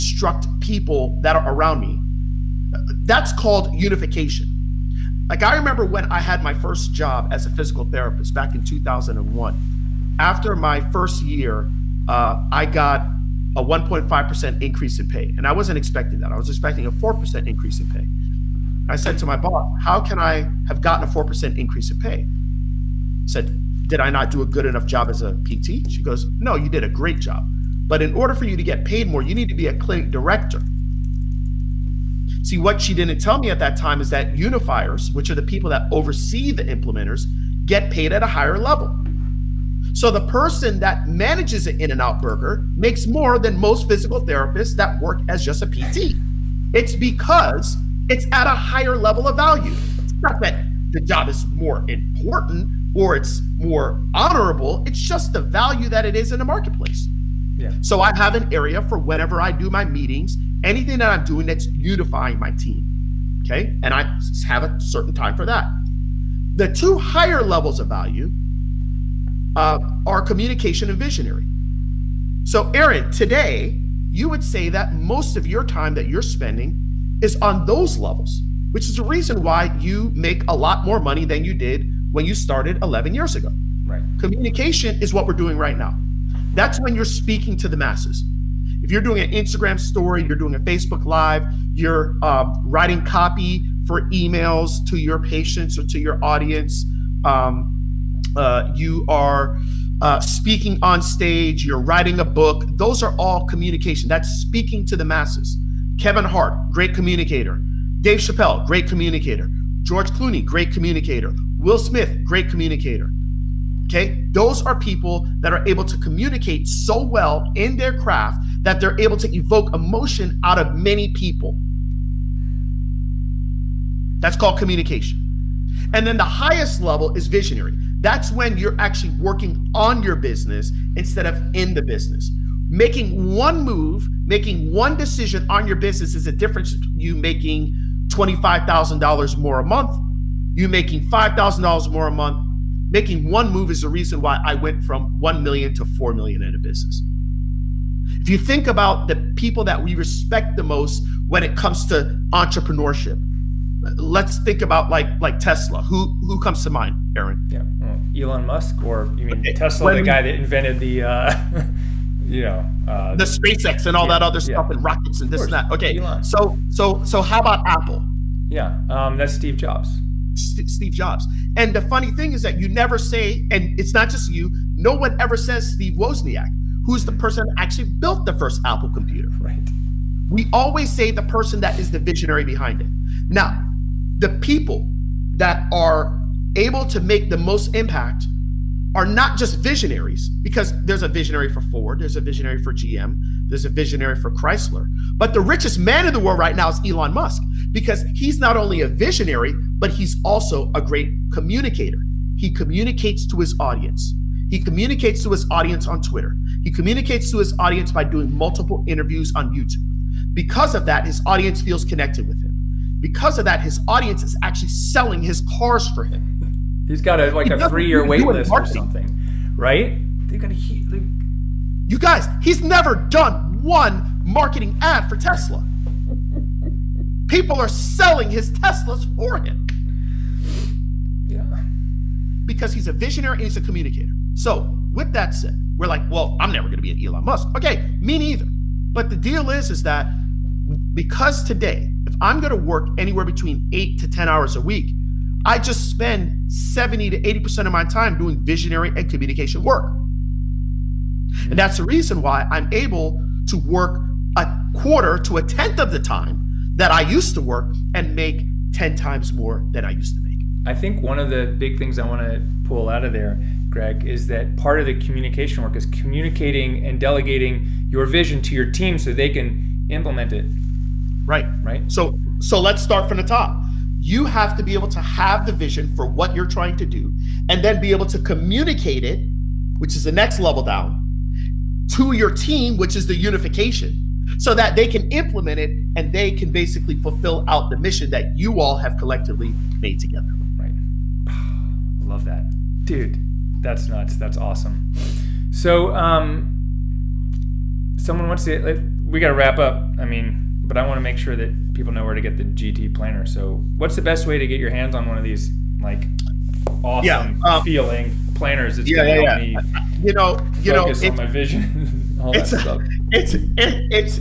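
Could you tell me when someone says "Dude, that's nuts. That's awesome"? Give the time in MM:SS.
04:52.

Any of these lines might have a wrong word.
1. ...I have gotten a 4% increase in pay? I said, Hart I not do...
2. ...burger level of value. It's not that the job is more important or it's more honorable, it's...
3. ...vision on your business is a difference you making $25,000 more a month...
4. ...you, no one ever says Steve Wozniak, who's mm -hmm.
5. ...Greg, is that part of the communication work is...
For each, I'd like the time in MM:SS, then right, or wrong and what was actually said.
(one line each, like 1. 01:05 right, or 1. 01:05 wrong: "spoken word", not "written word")
1. 00:20 wrong: "Did", not "Hart"
2. 00:48 wrong: "higher", not "burger"
3. 02:14 wrong: "decision", not "vision"
4. 02:54 right
5. 04:23 right.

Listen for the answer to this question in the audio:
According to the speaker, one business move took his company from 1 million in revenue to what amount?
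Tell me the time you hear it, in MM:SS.
02:25.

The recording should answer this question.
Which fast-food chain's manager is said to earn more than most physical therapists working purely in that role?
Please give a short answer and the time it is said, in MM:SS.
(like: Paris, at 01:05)
In and Out, at 00:41.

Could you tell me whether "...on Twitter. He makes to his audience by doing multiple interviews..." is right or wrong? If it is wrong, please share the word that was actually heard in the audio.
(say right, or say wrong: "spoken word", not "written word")
wrong: "communicates", not "makes".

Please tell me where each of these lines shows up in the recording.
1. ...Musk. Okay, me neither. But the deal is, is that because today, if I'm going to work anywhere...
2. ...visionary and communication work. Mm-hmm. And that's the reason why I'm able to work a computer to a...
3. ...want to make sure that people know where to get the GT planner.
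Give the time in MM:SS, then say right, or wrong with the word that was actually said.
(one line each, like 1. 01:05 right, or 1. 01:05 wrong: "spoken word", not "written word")
1. 03:57 right
2. 04:08 wrong: "quarter", not "computer"
3. 05:00 right.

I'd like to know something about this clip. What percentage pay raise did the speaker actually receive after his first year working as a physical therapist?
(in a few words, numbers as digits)
1.5%.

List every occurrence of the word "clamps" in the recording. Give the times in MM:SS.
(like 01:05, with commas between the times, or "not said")
not said.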